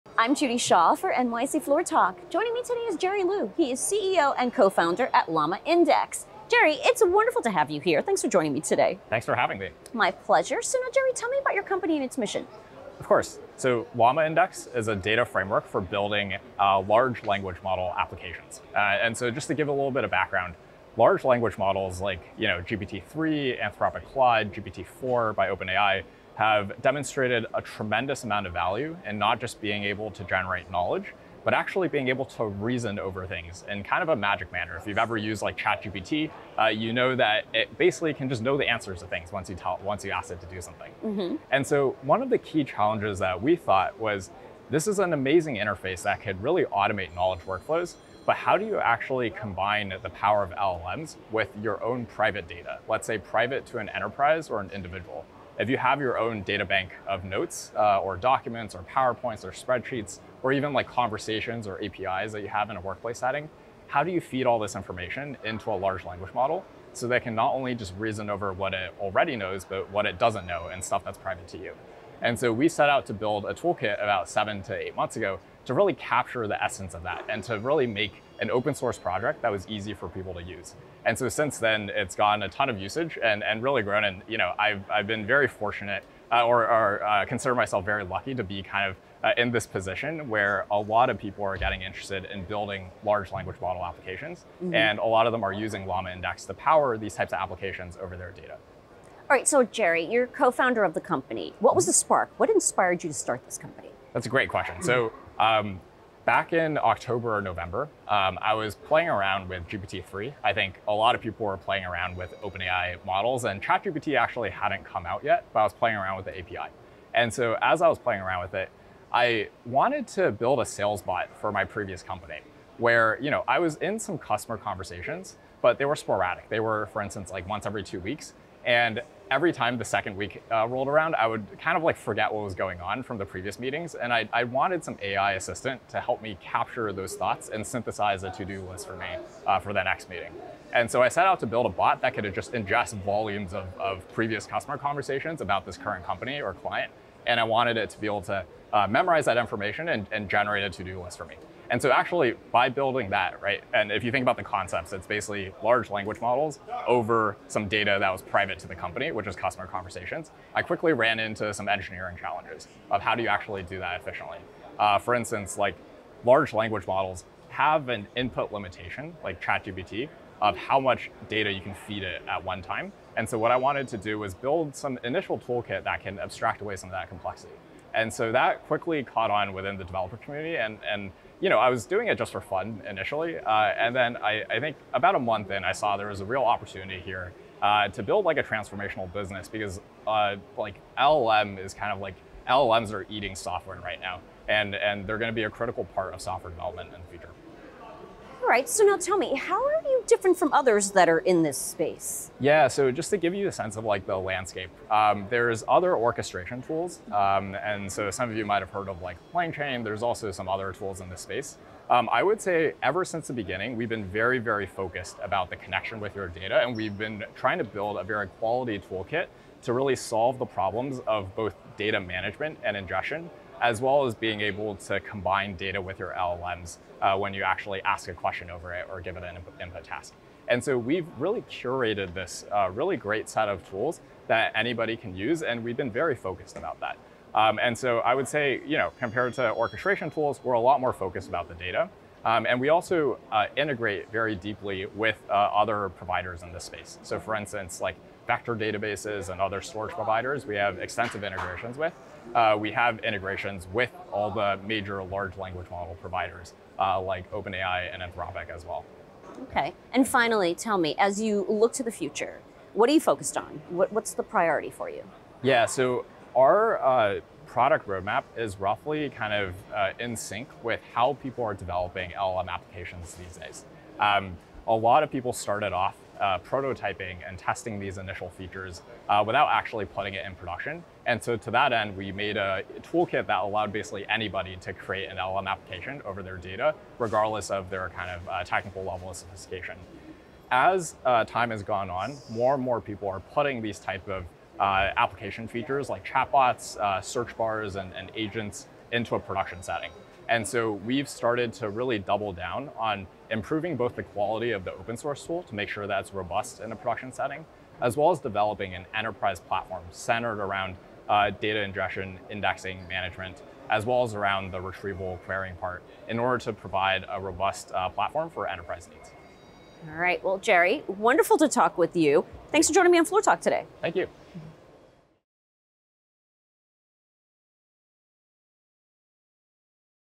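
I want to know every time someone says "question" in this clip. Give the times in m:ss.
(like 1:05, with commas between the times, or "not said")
1:44, 3:48.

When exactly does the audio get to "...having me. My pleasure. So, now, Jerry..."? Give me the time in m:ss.
0:09.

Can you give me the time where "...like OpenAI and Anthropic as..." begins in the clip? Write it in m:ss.
4:17.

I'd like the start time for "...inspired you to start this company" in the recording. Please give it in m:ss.
1:42.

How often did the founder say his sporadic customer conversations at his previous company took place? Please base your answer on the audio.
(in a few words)
Once every two weeks.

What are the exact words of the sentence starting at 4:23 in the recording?
What, what's the priority for you?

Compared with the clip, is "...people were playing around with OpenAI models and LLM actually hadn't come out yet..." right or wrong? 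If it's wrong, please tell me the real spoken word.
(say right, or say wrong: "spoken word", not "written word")
wrong: "ChatGPT", not "LLM".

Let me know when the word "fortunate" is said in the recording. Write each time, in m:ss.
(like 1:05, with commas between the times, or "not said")
1:25.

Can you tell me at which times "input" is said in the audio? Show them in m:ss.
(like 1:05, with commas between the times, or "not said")
2:48, 3:49.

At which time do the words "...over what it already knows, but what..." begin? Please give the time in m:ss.
1:08.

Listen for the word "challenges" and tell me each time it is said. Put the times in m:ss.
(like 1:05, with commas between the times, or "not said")
0:42, 2:42.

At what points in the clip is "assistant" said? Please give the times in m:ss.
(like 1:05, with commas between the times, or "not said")
2:15.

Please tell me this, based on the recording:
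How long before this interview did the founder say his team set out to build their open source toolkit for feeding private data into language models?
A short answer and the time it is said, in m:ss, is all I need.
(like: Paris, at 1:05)
7 to 8 months, at 1:14.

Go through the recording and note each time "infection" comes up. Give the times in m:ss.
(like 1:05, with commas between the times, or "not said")
not said.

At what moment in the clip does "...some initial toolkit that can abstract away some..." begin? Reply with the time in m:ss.
2:54.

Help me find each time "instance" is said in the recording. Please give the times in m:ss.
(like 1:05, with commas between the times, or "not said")
2:07, 2:45, 4:07.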